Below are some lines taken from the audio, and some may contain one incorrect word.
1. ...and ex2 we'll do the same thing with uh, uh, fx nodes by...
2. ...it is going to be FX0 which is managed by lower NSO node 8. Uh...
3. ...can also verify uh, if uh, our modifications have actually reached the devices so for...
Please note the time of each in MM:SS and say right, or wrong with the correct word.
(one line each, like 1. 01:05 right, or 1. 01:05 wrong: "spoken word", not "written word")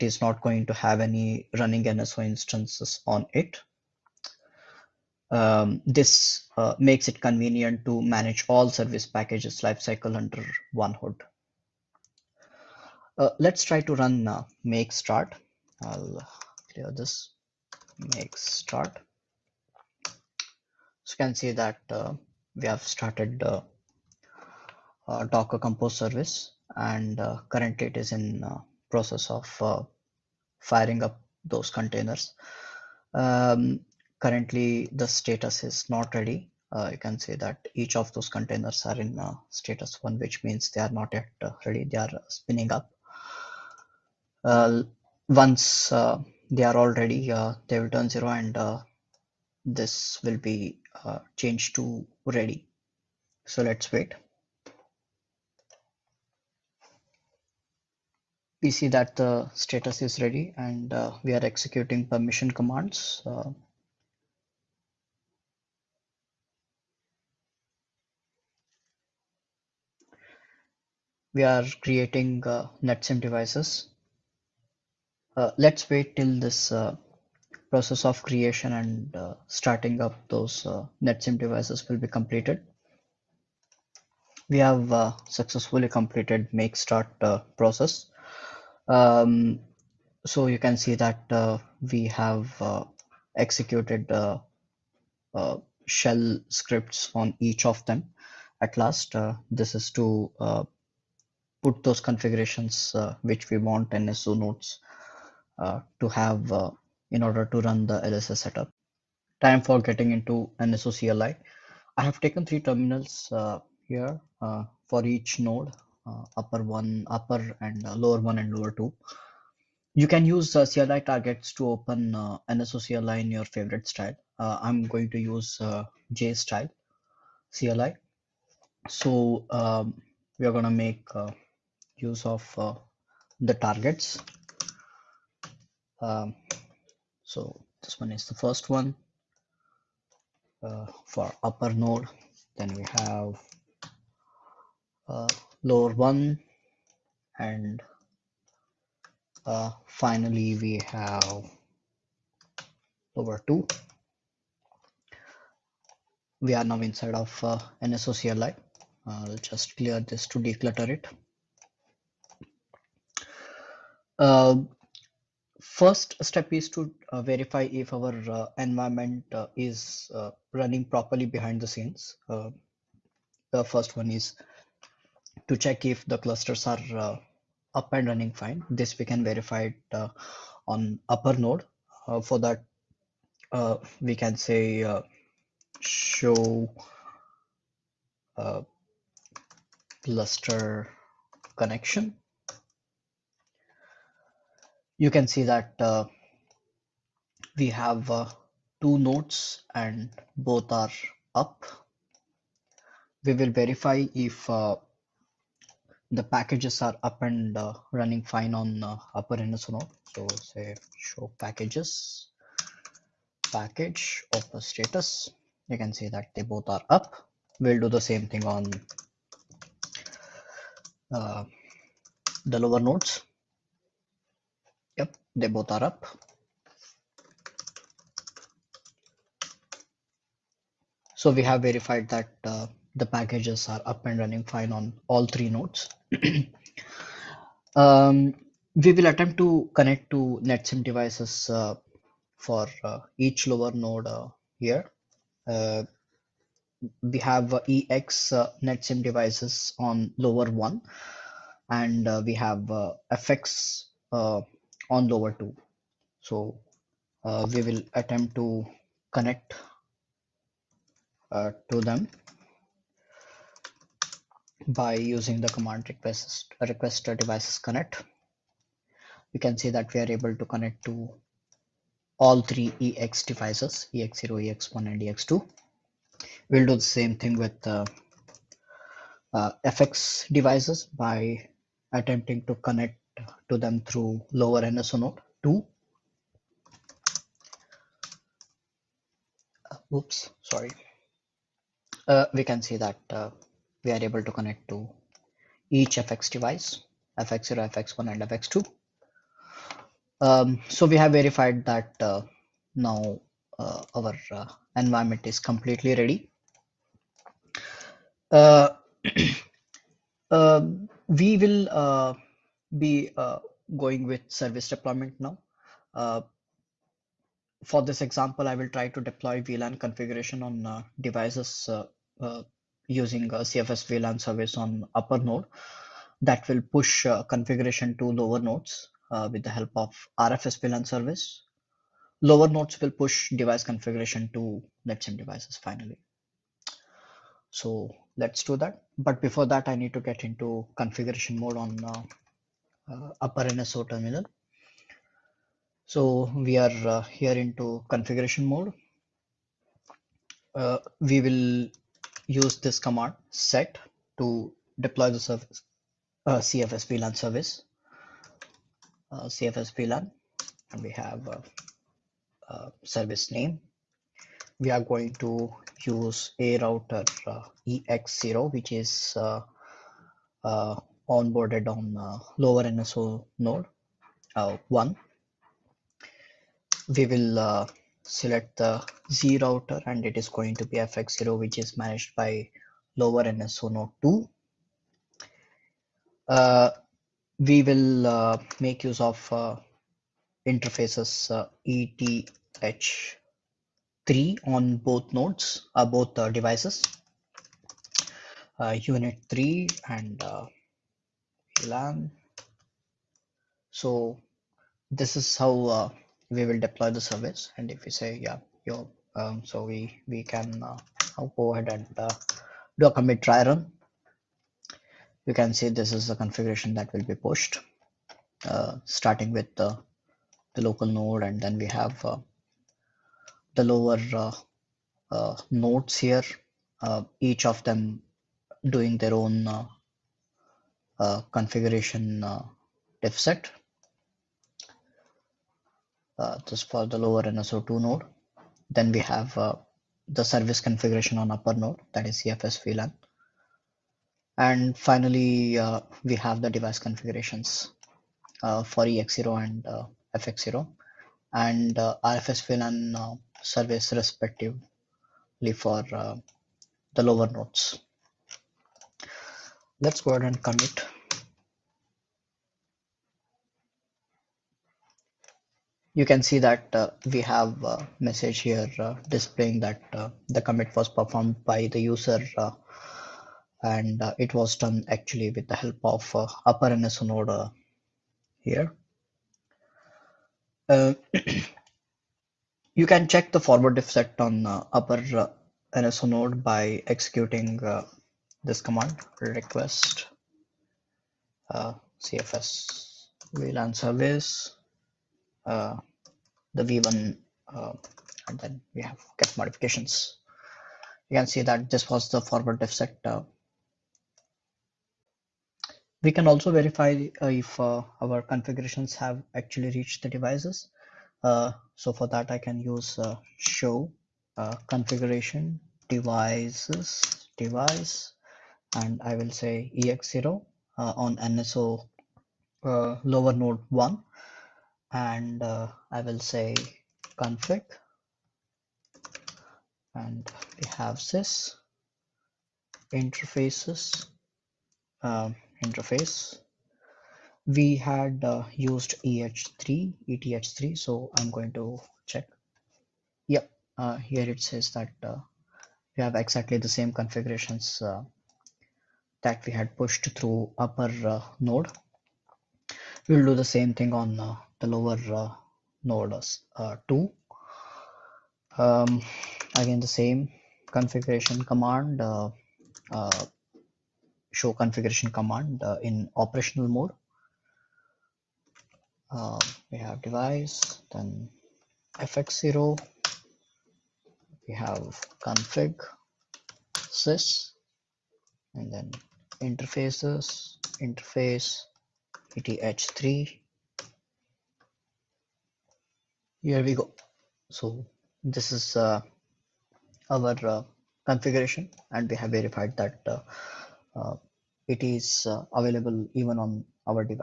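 1. 04:34 wrong: "devices", not "nodes"
2. 06:20 wrong: "2", not "8"
3. 08:26 wrong: "configurations", not "modifications".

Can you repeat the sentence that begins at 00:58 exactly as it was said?
we see that the status is ready and uh, we are executing permission commands.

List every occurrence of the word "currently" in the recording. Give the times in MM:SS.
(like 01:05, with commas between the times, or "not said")
00:27, 00:34.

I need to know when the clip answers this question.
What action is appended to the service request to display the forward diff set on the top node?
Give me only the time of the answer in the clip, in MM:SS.
08:19.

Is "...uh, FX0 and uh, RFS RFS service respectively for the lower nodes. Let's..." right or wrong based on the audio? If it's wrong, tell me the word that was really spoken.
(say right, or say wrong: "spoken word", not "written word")
wrong: "VLAN", not "RFS".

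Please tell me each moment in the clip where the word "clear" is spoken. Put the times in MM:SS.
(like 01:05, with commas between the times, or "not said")
00:16, 02:39.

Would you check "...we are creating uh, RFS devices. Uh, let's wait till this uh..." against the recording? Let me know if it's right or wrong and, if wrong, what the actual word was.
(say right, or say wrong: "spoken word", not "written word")
wrong: "NetSIM", not "RFS".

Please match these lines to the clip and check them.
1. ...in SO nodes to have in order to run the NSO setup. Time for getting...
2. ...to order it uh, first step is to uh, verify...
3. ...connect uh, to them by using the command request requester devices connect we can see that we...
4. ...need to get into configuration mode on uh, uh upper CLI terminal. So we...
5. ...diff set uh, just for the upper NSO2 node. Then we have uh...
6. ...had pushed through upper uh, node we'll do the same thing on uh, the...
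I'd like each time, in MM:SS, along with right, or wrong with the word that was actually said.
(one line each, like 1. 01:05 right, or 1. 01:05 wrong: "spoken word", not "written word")
1. 01:43 wrong: "LSA", not "NSO"
2. 02:40 wrong: "declutter", not "order"
3. 04:19 right
4. 05:39 wrong: "NSO", not "CLI"
5. 07:13 wrong: "lower", not "upper"
6. 09:09 right.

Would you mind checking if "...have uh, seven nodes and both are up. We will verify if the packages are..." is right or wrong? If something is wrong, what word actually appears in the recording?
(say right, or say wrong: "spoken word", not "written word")
wrong: "two", not "seven".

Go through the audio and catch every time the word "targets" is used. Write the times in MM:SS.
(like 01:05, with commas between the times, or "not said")
02:00, 02:13.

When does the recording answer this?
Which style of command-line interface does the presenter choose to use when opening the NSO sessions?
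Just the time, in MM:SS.
02:06.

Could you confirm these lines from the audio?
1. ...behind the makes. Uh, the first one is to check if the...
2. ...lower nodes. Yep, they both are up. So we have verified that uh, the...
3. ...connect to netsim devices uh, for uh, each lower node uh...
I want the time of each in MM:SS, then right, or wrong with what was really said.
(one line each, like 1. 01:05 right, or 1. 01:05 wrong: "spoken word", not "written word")
1. 02:51 wrong: "scenes", not "makes"
2. 03:42 right
3. 03:59 right.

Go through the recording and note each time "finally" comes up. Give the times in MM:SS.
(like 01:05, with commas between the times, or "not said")
02:29, 05:35, 07:24.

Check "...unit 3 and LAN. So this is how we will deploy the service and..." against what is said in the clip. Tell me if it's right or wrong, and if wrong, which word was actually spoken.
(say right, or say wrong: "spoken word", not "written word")
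right.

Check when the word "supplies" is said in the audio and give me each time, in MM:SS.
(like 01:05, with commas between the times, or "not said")
not said.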